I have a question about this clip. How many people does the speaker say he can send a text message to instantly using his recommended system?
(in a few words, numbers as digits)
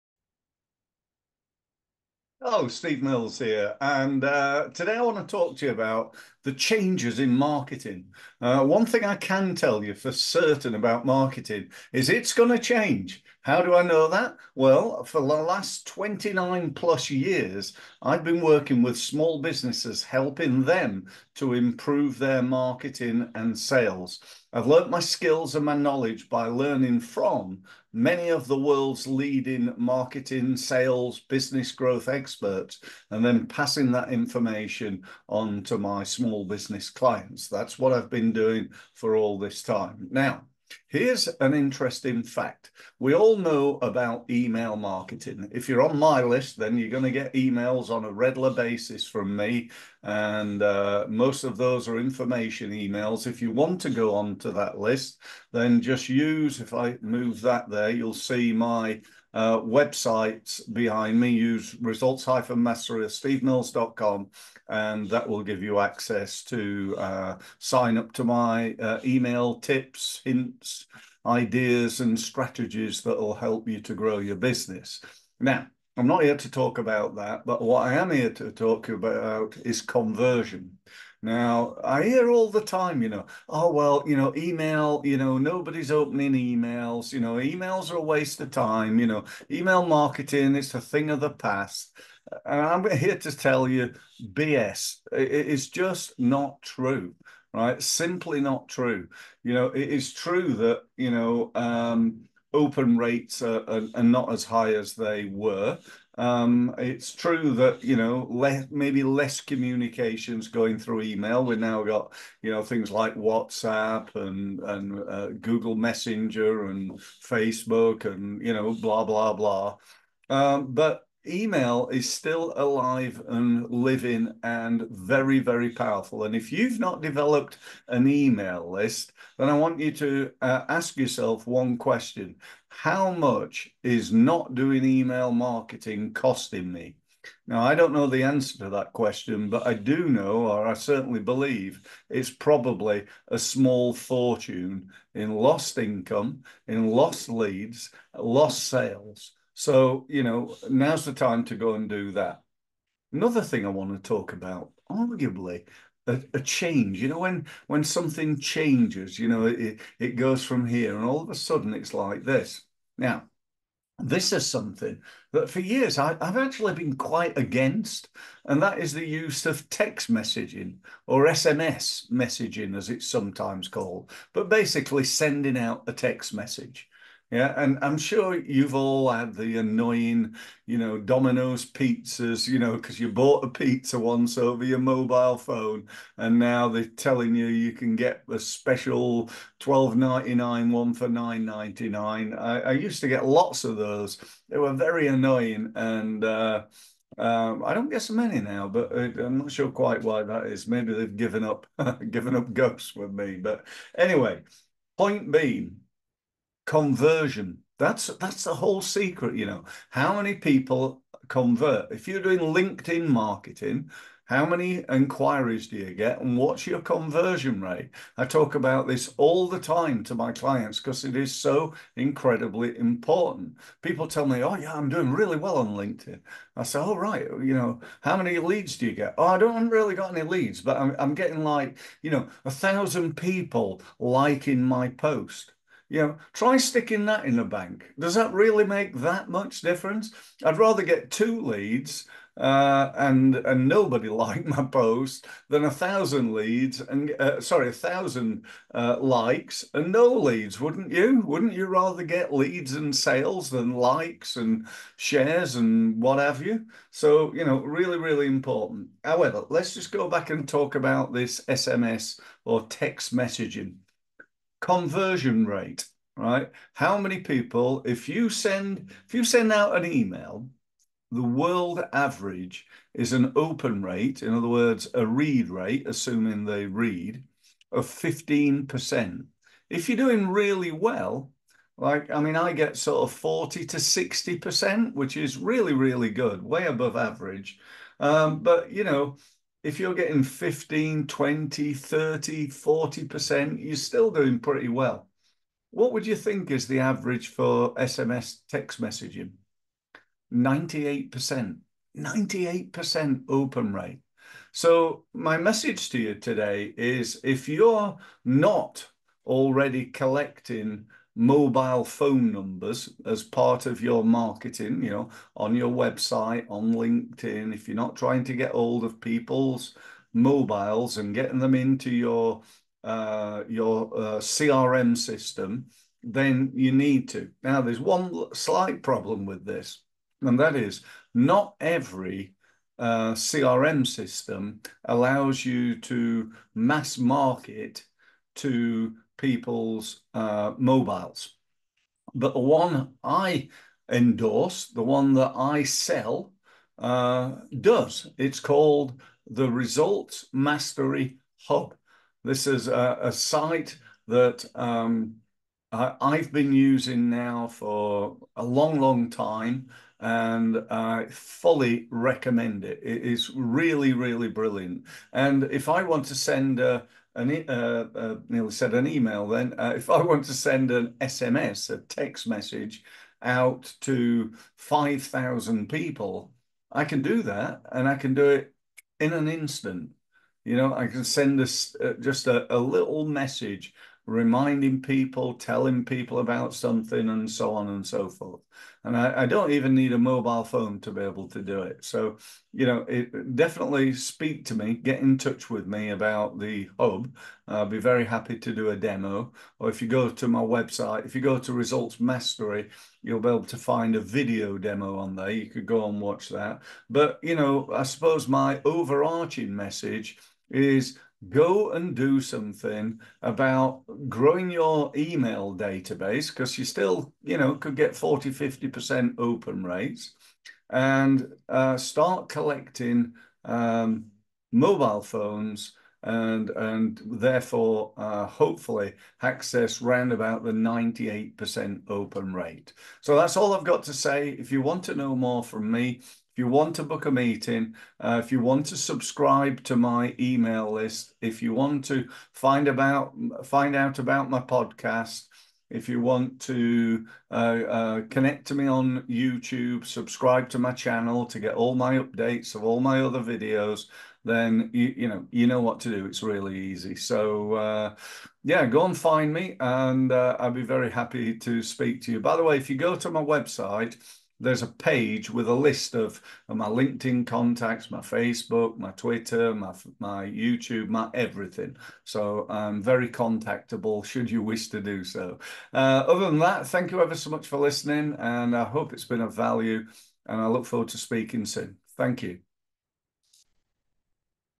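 5,000.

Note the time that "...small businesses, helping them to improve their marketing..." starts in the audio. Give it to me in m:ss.
0:18.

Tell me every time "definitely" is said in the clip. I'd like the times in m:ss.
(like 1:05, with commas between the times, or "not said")
6:33.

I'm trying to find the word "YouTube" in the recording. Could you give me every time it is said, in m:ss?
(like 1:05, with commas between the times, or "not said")
7:29, 7:50.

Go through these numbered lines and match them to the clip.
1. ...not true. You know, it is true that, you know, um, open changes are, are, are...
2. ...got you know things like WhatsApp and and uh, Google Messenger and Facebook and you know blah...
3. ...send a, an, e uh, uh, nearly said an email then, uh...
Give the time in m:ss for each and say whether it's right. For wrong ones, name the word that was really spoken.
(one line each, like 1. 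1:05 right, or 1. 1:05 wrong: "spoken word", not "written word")
1. 1:38 wrong: "rates", not "changes"
2. 1:51 right
3. 6:06 right.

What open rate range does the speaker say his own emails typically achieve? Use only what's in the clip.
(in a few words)
40 to 60%.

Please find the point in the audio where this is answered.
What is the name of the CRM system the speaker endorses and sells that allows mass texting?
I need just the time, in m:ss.
5:49.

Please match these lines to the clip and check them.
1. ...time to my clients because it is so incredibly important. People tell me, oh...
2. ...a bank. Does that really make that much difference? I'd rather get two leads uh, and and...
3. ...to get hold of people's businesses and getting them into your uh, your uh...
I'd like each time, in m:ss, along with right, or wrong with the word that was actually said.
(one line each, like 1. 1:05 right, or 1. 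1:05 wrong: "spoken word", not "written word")
1. 3:39 right
2. 3:57 right
3. 5:18 wrong: "mobiles", not "businesses".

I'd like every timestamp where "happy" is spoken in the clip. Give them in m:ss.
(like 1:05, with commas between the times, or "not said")
6:38, 7:40.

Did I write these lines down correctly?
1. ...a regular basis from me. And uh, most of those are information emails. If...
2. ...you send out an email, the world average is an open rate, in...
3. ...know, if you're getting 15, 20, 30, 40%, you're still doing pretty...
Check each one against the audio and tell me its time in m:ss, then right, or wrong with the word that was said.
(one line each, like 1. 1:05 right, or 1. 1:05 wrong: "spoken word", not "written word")
1. 0:48 right
2. 4:29 right
3. 4:48 right.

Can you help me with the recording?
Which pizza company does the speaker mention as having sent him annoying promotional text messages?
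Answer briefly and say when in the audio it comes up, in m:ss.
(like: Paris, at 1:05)
Domino's, at 3:00.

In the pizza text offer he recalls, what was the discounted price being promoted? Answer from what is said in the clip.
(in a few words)
9.99.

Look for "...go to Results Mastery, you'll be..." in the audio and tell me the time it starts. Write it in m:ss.
6:41.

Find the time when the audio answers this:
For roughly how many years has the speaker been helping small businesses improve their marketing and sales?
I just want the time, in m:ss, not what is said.
0:15.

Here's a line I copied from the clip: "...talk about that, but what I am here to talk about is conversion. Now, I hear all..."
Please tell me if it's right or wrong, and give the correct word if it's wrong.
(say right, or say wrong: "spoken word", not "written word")
right.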